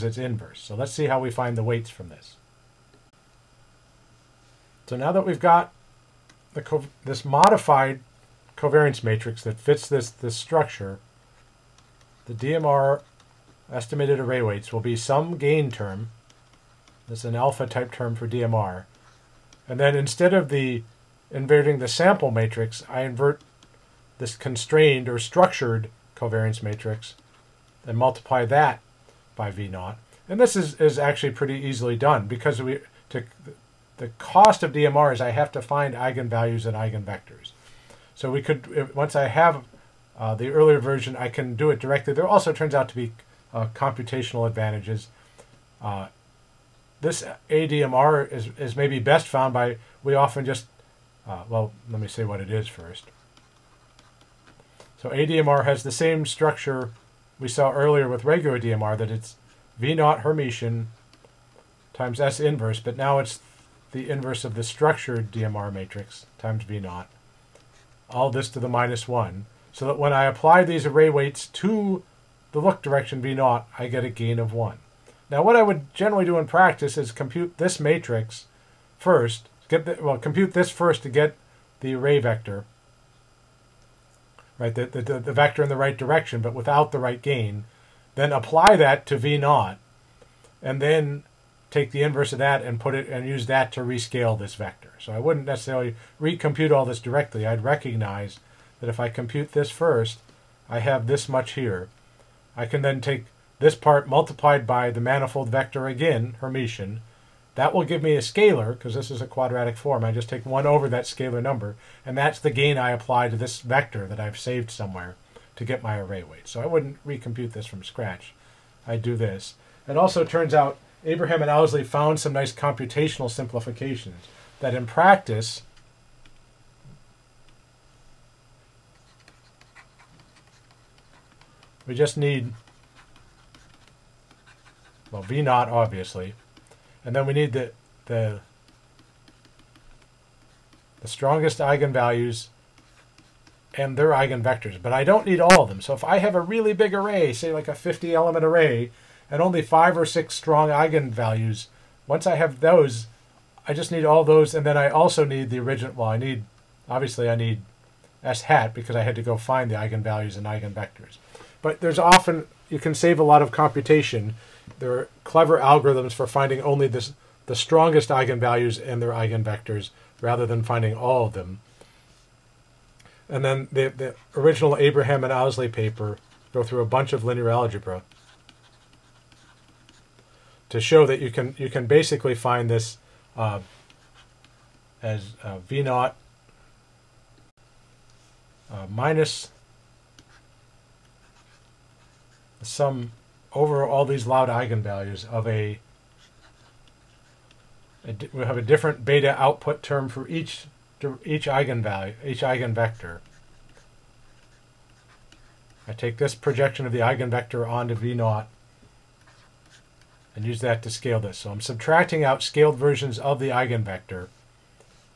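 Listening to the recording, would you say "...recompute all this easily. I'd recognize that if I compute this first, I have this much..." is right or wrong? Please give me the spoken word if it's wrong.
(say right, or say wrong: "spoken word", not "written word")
wrong: "directly", not "easily".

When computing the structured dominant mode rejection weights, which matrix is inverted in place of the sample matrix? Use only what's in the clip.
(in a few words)
Constrained or structured covariance matrix.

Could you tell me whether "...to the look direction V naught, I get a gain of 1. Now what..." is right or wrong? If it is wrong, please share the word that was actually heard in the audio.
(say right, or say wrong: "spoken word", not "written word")
right.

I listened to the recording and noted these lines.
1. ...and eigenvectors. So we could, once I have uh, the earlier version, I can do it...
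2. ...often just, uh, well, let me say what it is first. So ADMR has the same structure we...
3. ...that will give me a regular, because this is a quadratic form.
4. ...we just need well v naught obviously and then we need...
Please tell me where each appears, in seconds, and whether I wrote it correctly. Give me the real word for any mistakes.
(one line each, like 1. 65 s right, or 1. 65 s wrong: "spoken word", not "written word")
1. 36 s right
2. 50 s right
3. 107 s wrong: "scalar", not "regular"
4. 131 s right.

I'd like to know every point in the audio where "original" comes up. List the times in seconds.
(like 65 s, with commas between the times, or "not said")
155 s, 174 s.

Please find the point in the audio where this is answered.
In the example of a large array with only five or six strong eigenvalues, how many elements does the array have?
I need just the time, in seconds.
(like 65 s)
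147 s.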